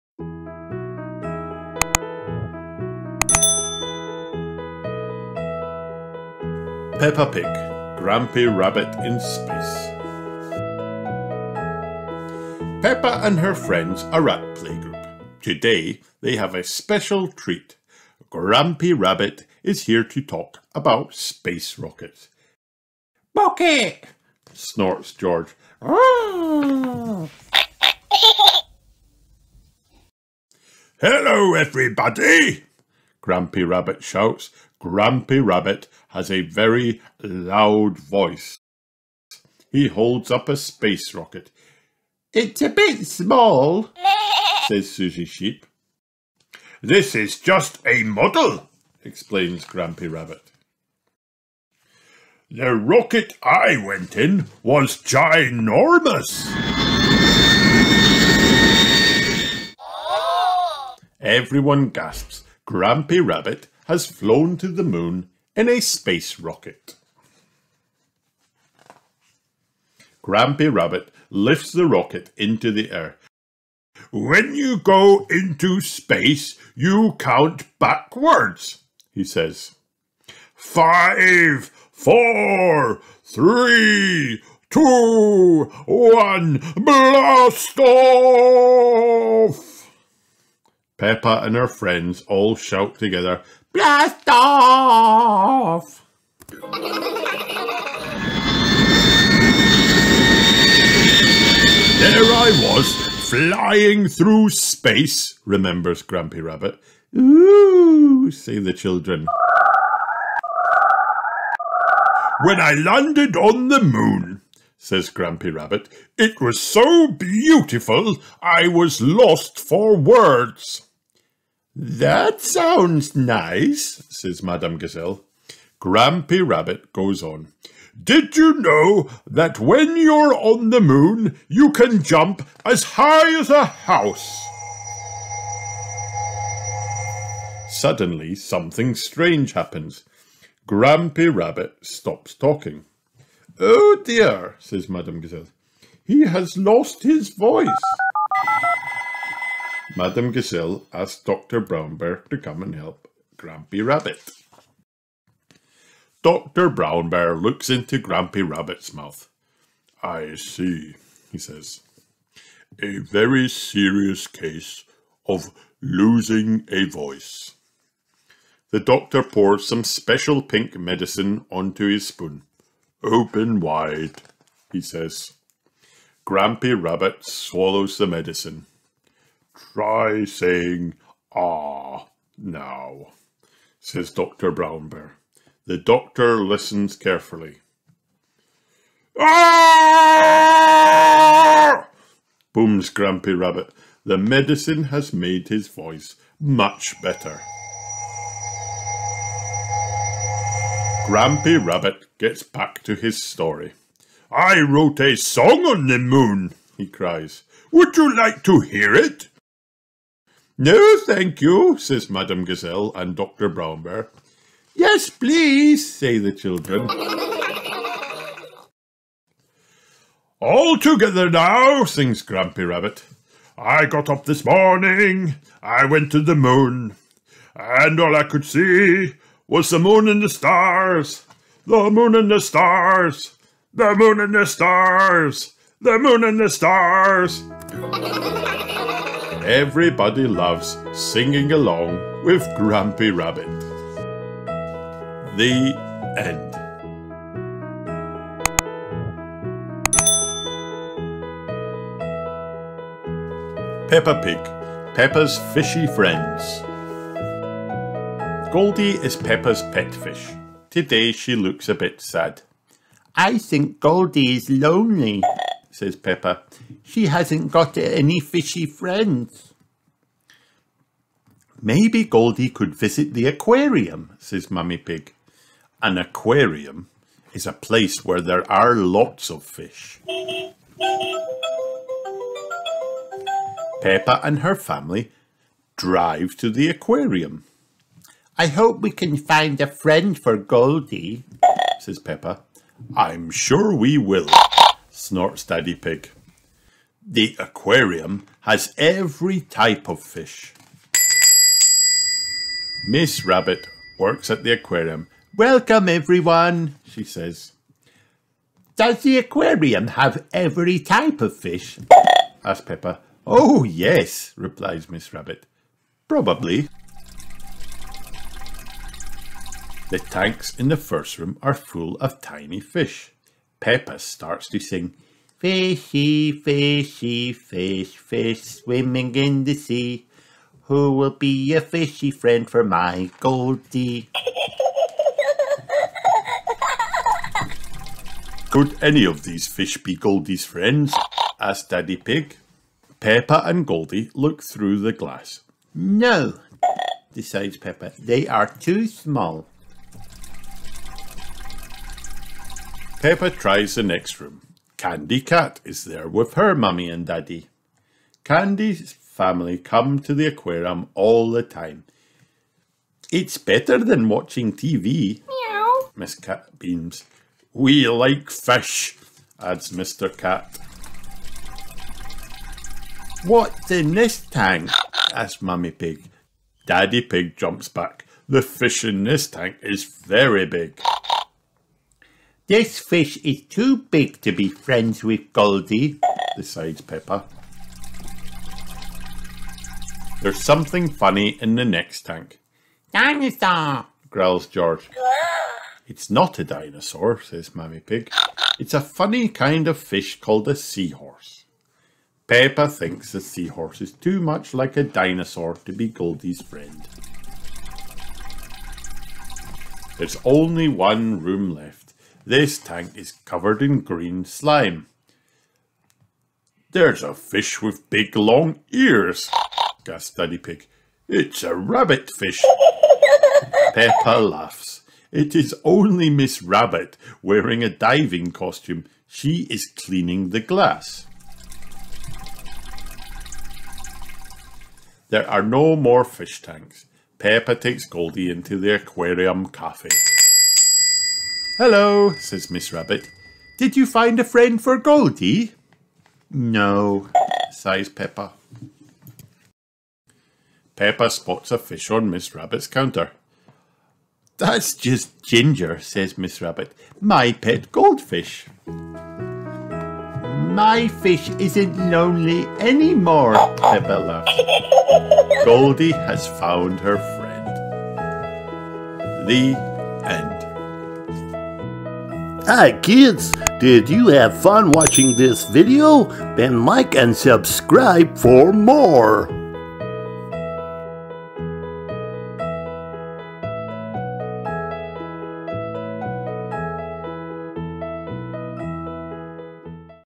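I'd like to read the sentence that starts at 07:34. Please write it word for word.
That's just Ginger, says Miss Rabbit.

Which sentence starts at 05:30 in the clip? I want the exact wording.
Who will be a fishy friend for my Goldie?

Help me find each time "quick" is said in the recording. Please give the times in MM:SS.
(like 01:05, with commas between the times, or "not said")
not said.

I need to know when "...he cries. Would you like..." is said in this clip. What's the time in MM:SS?
03:26.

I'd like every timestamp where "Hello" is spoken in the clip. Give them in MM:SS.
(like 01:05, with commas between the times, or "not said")
00:31, 07:21.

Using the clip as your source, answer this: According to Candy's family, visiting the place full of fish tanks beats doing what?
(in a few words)
watching TV.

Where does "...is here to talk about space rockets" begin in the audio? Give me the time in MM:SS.
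00:19.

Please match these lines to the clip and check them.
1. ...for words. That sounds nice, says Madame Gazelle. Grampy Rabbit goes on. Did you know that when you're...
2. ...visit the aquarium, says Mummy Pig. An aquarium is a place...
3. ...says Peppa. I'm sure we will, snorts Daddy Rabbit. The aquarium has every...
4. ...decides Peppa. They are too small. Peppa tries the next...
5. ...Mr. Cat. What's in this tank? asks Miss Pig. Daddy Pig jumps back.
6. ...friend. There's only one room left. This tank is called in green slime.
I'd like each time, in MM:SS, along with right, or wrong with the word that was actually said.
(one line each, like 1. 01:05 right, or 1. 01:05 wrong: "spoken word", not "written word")
1. 01:59 right
2. 04:32 right
3. 04:51 wrong: "Pig", not "Rabbit"
4. 05:47 right
5. 06:09 wrong: "Mummy", not "Miss"
6. 06:46 wrong: "covered", not "called".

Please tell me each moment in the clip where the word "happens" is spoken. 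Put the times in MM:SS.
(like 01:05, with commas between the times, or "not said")
02:19.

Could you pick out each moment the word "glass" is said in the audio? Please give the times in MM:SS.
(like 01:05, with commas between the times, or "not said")
05:44, 07:10.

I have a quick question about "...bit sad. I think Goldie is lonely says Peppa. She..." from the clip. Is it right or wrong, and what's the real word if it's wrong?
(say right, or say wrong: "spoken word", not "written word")
right.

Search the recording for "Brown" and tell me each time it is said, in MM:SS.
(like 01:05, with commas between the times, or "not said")
02:31, 02:36, 03:04, 03:33.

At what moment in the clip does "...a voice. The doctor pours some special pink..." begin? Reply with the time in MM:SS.
02:46.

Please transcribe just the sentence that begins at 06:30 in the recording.
There's something funny in the next tank.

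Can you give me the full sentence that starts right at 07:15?
There are no more fish tanks.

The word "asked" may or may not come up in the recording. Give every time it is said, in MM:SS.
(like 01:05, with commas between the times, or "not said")
02:30, 05:41.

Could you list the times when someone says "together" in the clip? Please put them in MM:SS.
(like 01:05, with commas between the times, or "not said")
01:32, 03:40.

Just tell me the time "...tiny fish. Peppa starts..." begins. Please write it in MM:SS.
05:22.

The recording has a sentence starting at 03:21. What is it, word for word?
Grampy Rabbit gets back to his story.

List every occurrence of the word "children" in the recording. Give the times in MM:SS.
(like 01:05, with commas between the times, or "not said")
01:48, 03:36.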